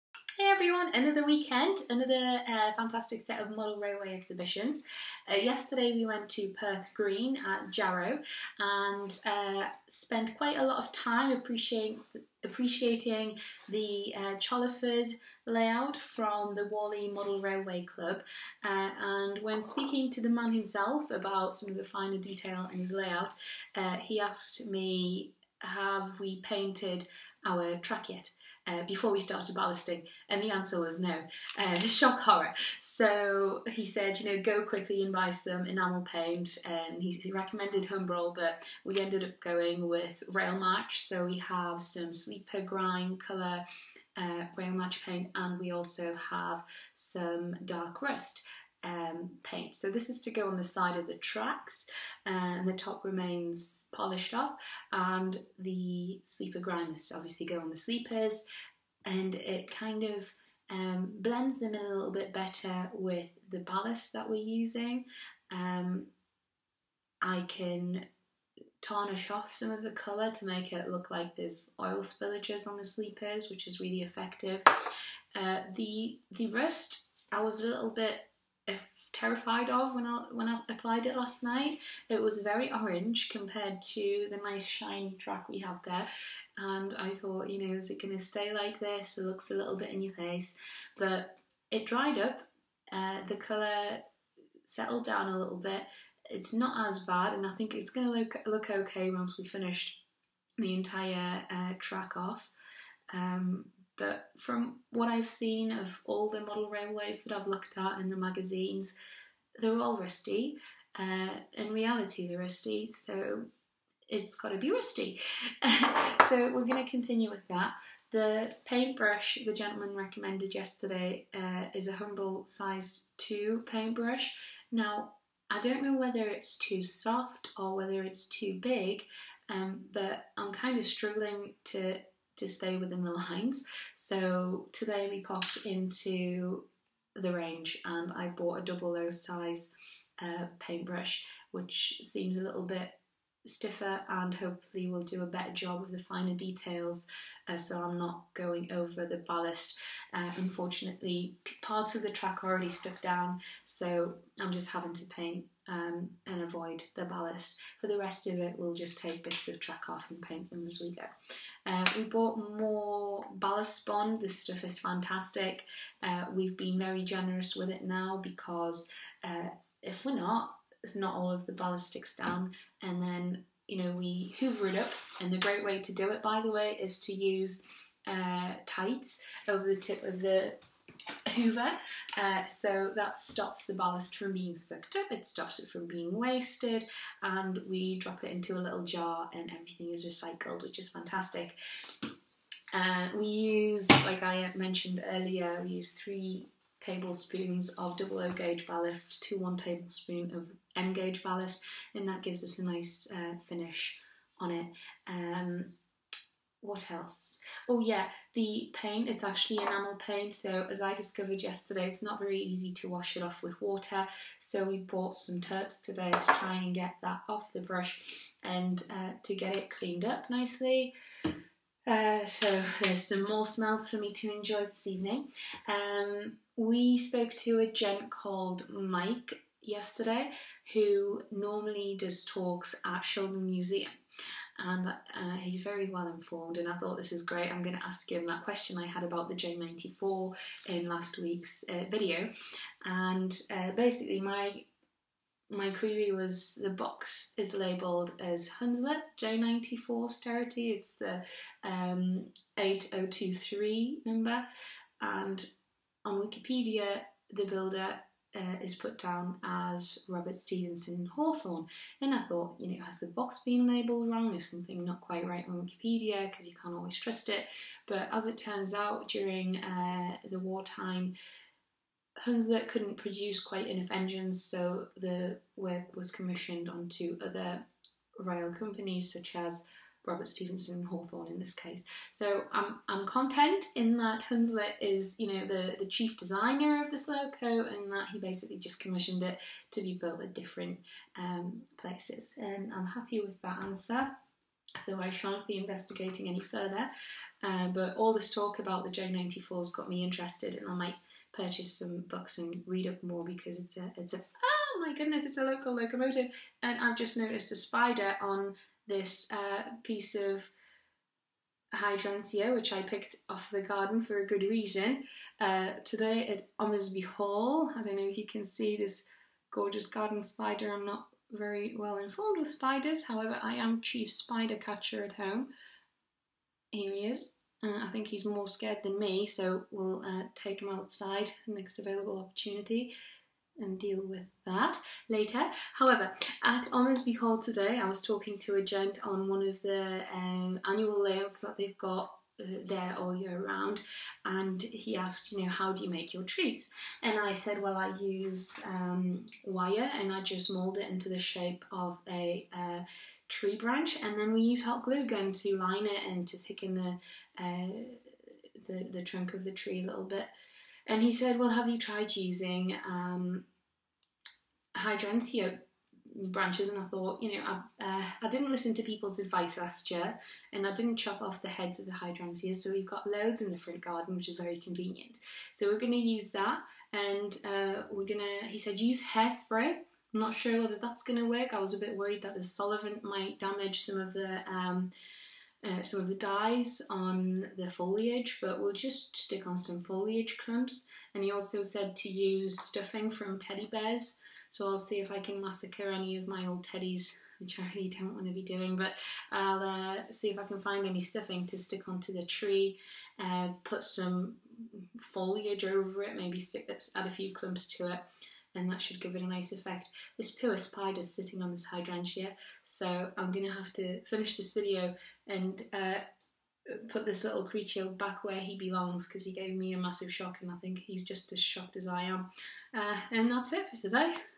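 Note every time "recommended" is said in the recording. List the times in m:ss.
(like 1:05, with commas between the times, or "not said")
0:37, 1:59.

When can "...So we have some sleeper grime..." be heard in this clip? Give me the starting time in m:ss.
0:40.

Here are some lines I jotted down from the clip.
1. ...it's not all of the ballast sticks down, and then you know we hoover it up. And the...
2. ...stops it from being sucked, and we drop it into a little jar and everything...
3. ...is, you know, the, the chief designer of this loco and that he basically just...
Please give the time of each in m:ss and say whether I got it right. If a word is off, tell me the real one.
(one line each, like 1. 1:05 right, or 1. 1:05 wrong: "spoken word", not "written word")
1. 2:50 right
2. 3:05 wrong: "wasted", not "sucked"
3. 4:44 right.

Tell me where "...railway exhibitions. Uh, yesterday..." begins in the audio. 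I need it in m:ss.
0:03.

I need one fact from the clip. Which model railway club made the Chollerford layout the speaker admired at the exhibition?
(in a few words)
Wally Model Railway Club.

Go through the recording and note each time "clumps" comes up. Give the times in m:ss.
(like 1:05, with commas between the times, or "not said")
6:30, 6:47.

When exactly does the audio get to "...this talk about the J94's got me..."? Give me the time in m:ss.
4:58.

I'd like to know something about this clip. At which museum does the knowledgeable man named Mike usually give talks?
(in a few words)
Shildon Museum.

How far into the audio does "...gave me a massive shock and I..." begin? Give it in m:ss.
6:59.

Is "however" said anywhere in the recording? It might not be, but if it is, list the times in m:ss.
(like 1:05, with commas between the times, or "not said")
5:23, 5:35.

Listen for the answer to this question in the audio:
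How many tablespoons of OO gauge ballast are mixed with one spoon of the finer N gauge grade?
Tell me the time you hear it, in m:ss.
3:15.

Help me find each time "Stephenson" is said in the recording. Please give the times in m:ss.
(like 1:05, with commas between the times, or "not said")
4:20, 4:40.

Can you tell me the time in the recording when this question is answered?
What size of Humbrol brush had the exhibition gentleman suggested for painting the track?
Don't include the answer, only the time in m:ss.
2:02.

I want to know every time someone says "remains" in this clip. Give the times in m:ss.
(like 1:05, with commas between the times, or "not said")
0:53.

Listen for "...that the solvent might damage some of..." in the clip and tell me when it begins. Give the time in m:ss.
6:22.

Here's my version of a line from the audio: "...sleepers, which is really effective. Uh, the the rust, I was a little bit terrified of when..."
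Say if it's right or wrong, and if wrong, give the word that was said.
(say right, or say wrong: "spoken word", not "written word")
right.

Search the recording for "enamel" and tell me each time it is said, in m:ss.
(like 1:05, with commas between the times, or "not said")
0:35, 3:29.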